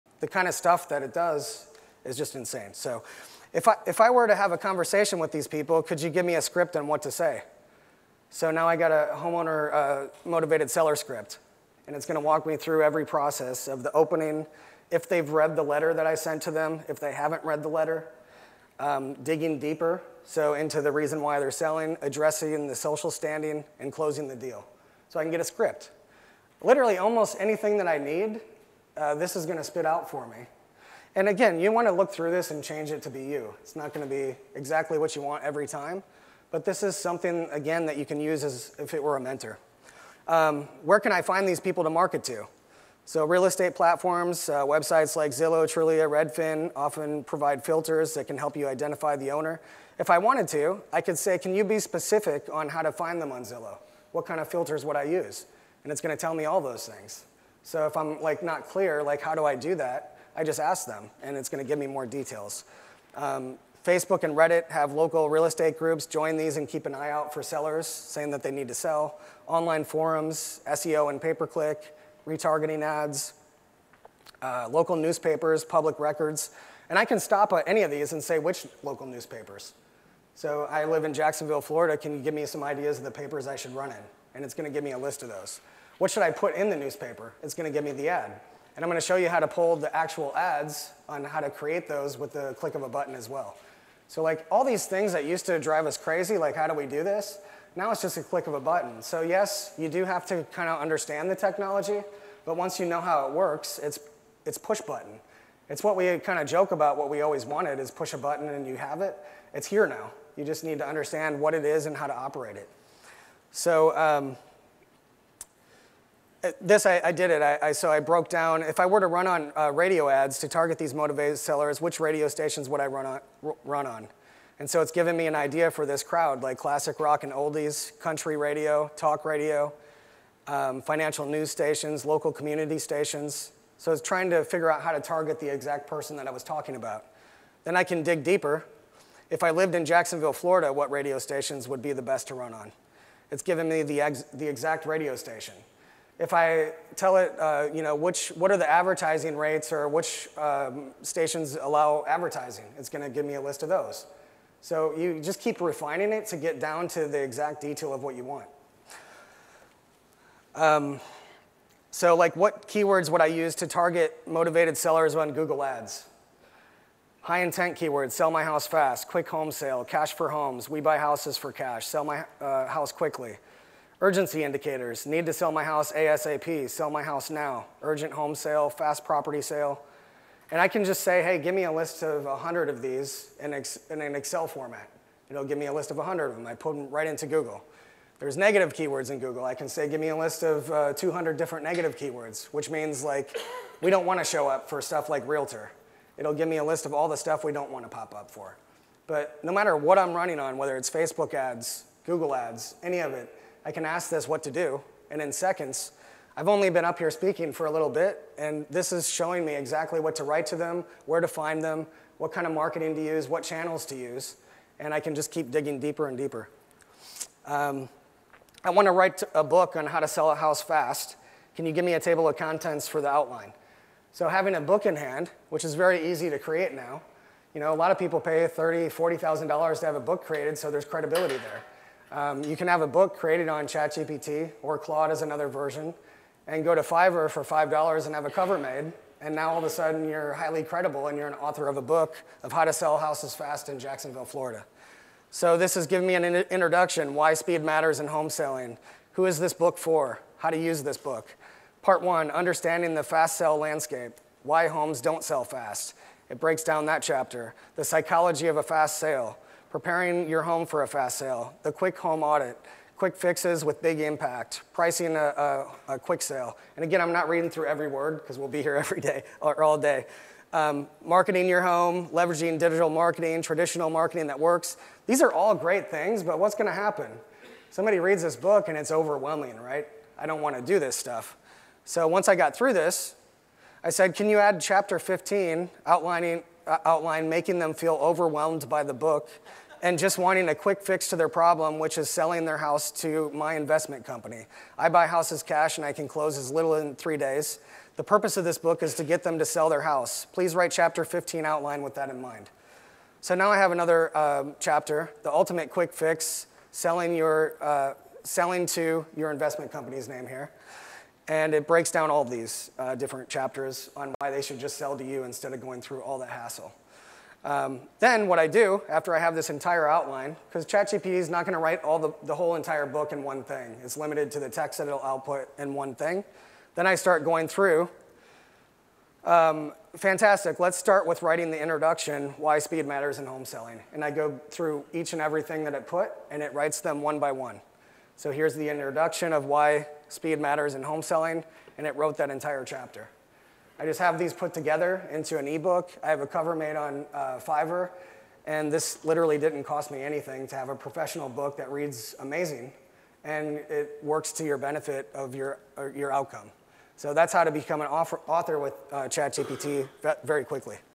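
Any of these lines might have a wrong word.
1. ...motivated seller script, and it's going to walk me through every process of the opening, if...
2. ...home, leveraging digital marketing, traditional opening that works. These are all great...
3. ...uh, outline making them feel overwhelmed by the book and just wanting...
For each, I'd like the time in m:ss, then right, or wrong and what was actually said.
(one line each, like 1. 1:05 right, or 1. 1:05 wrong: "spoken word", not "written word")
1. 0:10 right
2. 4:31 wrong: "marketing", not "opening"
3. 4:46 right.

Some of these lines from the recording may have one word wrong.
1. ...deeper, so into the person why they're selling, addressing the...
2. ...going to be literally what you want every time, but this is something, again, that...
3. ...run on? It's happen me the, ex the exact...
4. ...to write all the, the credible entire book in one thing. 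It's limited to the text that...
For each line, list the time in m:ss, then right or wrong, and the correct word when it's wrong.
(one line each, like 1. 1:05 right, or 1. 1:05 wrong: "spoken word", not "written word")
1. 0:19 wrong: "reason", not "person"
2. 0:33 wrong: "exactly", not "literally"
3. 2:22 wrong: "given", not "happen"
4. 5:21 wrong: "whole", not "credible".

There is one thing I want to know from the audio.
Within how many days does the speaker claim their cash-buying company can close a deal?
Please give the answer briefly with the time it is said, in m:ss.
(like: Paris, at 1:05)
3, at 4:56.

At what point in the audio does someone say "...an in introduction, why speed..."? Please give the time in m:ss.
4:06.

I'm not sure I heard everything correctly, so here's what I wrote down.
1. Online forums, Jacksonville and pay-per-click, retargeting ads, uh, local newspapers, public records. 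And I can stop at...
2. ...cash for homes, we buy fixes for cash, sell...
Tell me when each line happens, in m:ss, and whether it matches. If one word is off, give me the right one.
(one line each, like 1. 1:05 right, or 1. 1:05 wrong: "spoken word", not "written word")
1. 1:09 wrong: "SEO", not "Jacksonville"
2. 2:49 wrong: "houses", not "fixes".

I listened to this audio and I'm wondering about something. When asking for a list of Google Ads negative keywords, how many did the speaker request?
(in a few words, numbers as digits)
200.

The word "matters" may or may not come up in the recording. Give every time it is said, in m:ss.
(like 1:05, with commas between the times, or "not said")
3:19, 4:07, 5:32, 5:40.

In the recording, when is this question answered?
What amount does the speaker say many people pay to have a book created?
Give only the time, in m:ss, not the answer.
3:48.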